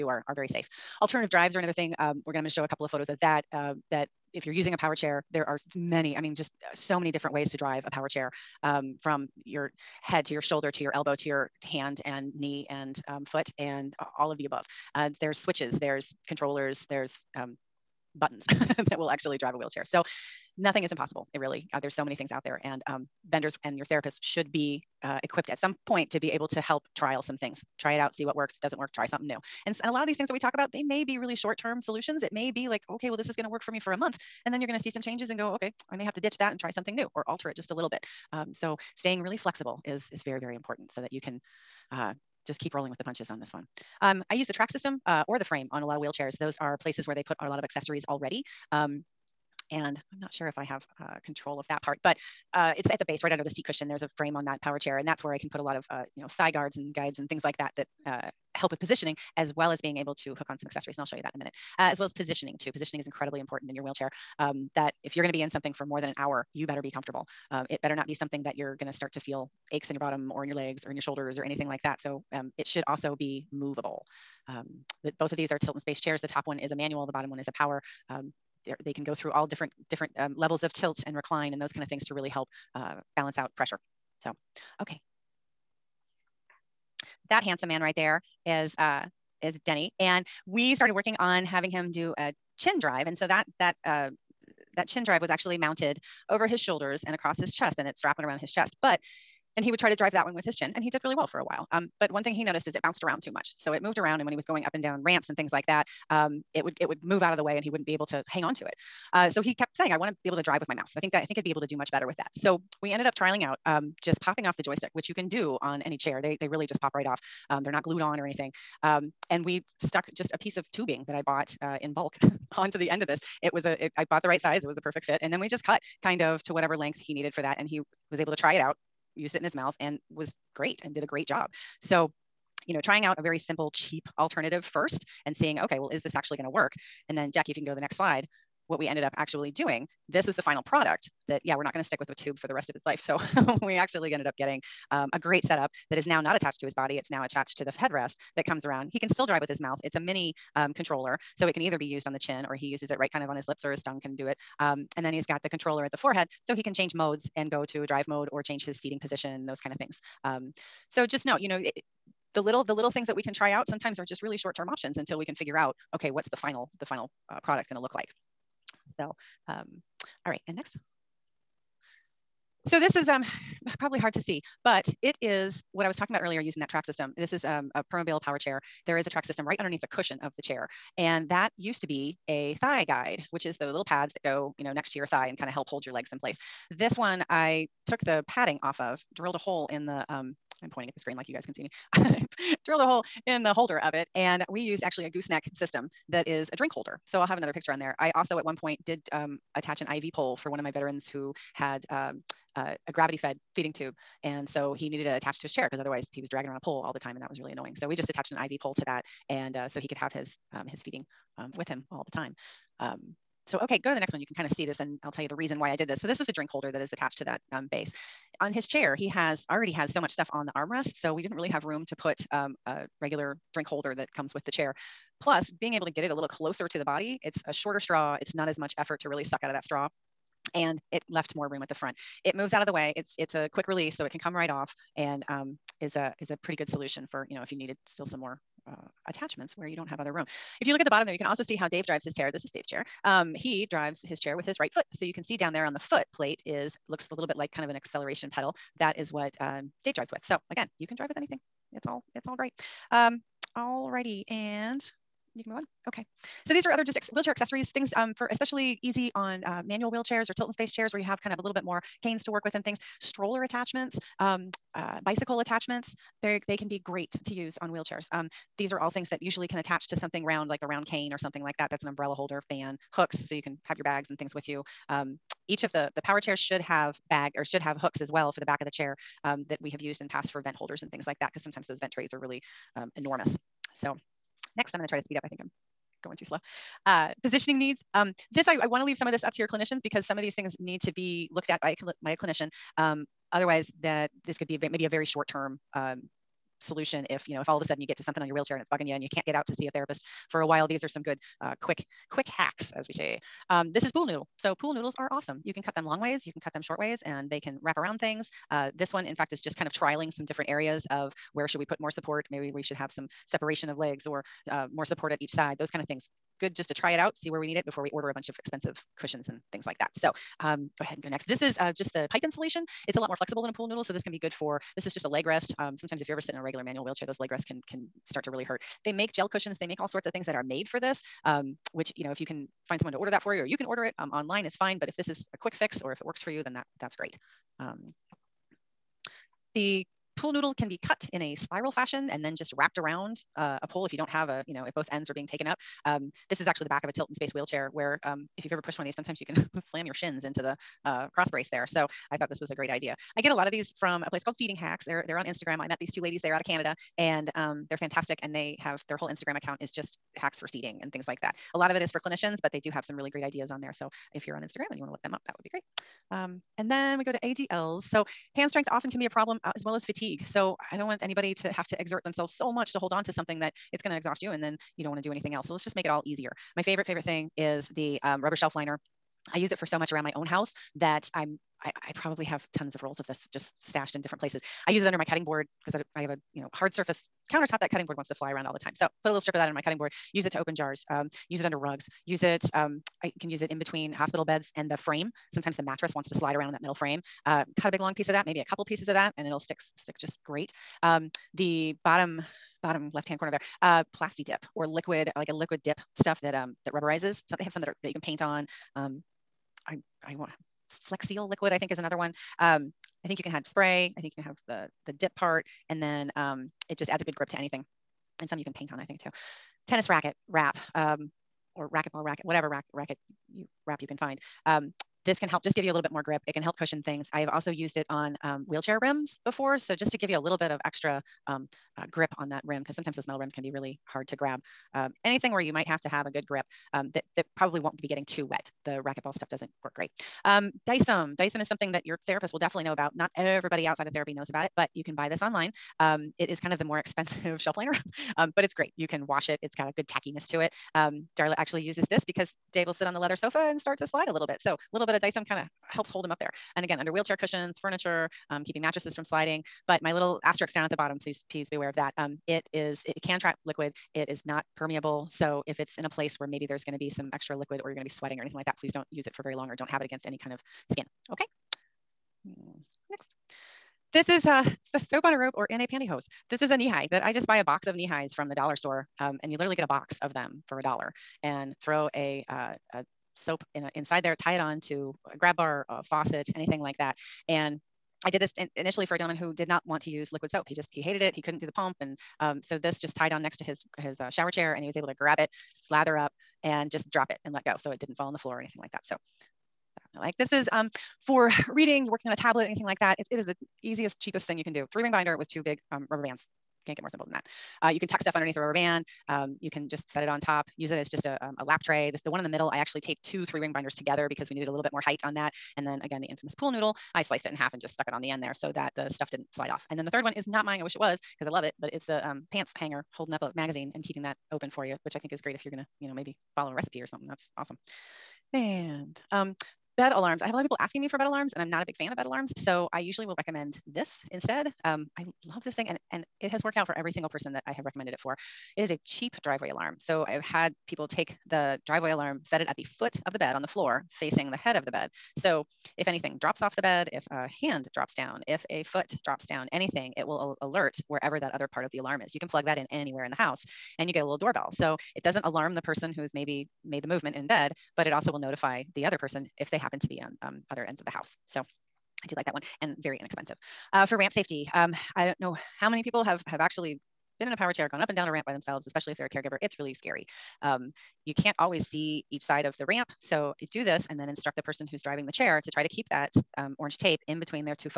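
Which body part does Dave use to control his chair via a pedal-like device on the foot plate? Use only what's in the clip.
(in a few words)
right foot.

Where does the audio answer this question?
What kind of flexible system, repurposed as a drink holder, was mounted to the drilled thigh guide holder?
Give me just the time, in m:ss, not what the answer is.
3:15.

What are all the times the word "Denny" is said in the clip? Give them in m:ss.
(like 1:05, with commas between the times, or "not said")
1:29.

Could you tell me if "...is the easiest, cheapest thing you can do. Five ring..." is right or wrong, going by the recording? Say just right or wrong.
wrong.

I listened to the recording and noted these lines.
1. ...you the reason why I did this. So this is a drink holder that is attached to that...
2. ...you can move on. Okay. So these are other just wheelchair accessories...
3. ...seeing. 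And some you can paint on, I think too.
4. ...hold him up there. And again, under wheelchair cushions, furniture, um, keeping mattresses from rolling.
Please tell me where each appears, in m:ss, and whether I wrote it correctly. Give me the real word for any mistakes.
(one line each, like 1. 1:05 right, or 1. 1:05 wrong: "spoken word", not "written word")
1. 3:35 right
2. 4:15 right
3. 6:57 wrong: "anything", not "seeing"
4. 7:35 wrong: "sliding", not "rolling".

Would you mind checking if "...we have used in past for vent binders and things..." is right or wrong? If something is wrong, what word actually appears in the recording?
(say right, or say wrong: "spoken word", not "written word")
wrong: "holders", not "binders".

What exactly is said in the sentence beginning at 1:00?
And I'll show you that in a minute, uh, as well as positioning too.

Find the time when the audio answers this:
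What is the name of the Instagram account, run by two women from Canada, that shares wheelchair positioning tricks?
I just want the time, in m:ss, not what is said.
5:54.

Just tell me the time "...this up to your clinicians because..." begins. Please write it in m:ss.
4:49.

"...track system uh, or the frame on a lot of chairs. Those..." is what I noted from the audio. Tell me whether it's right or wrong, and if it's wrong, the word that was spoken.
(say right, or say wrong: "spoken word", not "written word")
wrong: "wheelchairs", not "chairs".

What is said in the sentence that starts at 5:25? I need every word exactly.
Um, sometimes if you're ever sitting in a regular manual wheelchair, those leg rests can, can start to really hurt.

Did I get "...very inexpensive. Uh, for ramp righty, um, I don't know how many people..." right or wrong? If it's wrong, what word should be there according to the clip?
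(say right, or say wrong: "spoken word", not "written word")
wrong: "safety", not "righty".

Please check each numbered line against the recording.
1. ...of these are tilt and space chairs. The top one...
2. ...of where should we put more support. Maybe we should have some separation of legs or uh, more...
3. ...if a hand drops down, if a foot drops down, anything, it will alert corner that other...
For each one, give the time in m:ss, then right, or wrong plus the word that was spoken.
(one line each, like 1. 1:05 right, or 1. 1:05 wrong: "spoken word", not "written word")
1. 1:15 right
2. 5:10 right
3. 9:06 wrong: "wherever", not "corner".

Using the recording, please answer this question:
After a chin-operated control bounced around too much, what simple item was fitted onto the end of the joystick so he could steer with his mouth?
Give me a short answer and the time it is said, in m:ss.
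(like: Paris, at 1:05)
tubing, at 2:00.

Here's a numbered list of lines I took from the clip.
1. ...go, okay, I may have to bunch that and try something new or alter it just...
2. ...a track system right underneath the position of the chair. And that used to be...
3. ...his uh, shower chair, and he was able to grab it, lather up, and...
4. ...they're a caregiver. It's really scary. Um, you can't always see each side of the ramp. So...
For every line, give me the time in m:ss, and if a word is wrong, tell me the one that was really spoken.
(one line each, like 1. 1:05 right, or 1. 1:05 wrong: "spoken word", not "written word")
1. 0:35 wrong: "ditch", not "bunch"
2. 2:59 wrong: "cushion", not "position"
3. 8:13 right
4. 9:28 right.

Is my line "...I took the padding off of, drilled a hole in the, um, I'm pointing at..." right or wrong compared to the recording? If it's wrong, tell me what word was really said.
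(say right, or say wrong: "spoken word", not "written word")
right.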